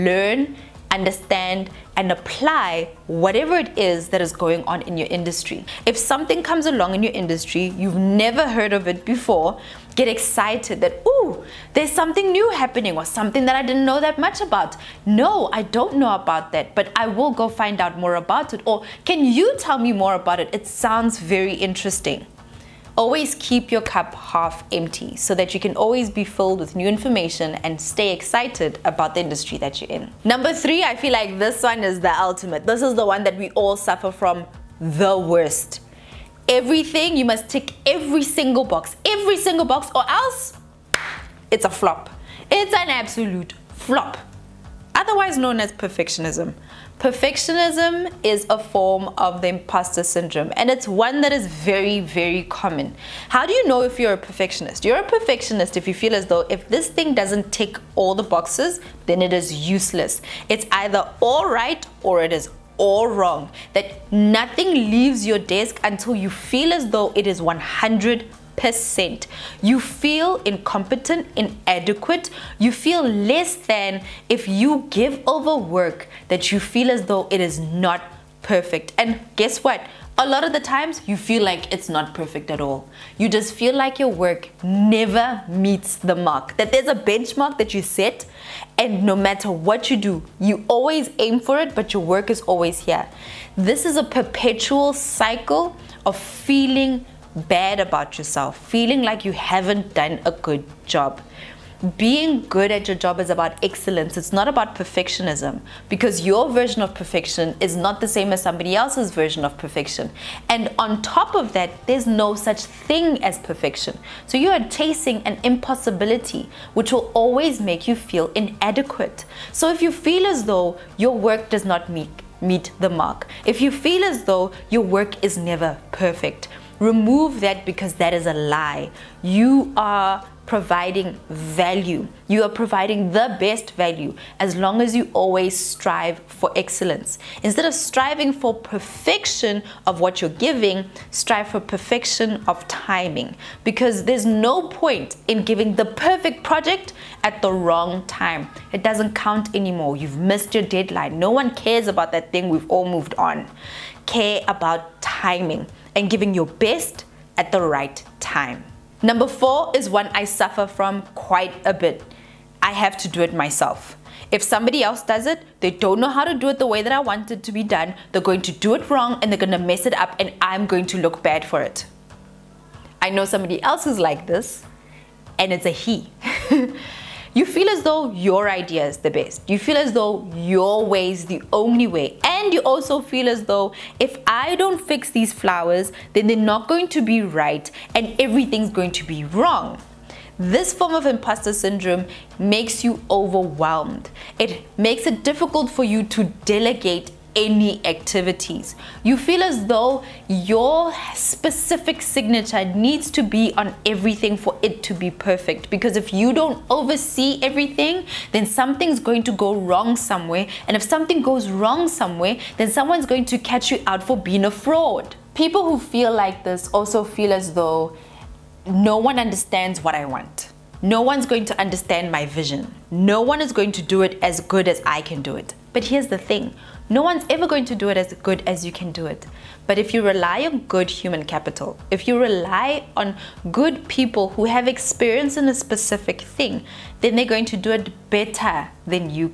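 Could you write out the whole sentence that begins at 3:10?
This form of imposter syndrome makes you overwhelmed.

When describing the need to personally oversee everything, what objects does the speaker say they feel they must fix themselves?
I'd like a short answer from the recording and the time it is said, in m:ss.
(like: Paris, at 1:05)
Flowers, at 3:05.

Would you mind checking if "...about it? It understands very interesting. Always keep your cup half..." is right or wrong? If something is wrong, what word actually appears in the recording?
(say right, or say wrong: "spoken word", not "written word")
wrong: "sounds", not "understands".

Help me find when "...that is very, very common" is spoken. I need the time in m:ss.
0:51.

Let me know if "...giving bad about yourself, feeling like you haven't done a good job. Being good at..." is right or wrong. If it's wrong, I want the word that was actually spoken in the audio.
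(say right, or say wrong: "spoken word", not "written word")
wrong: "feeling", not "giving".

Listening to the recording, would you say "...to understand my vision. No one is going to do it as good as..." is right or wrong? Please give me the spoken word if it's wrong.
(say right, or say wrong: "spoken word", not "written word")
right.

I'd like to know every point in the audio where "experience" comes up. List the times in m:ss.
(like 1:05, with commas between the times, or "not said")
3:54.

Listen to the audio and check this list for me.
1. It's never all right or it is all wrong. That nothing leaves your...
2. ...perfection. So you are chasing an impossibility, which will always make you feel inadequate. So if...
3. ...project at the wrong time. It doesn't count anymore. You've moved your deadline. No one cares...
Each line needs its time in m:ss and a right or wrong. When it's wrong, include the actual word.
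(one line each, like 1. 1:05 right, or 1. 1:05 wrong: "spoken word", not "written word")
1. 1:00 wrong: "either", not "never"
2. 1:53 right
3. 2:26 wrong: "missed", not "moved".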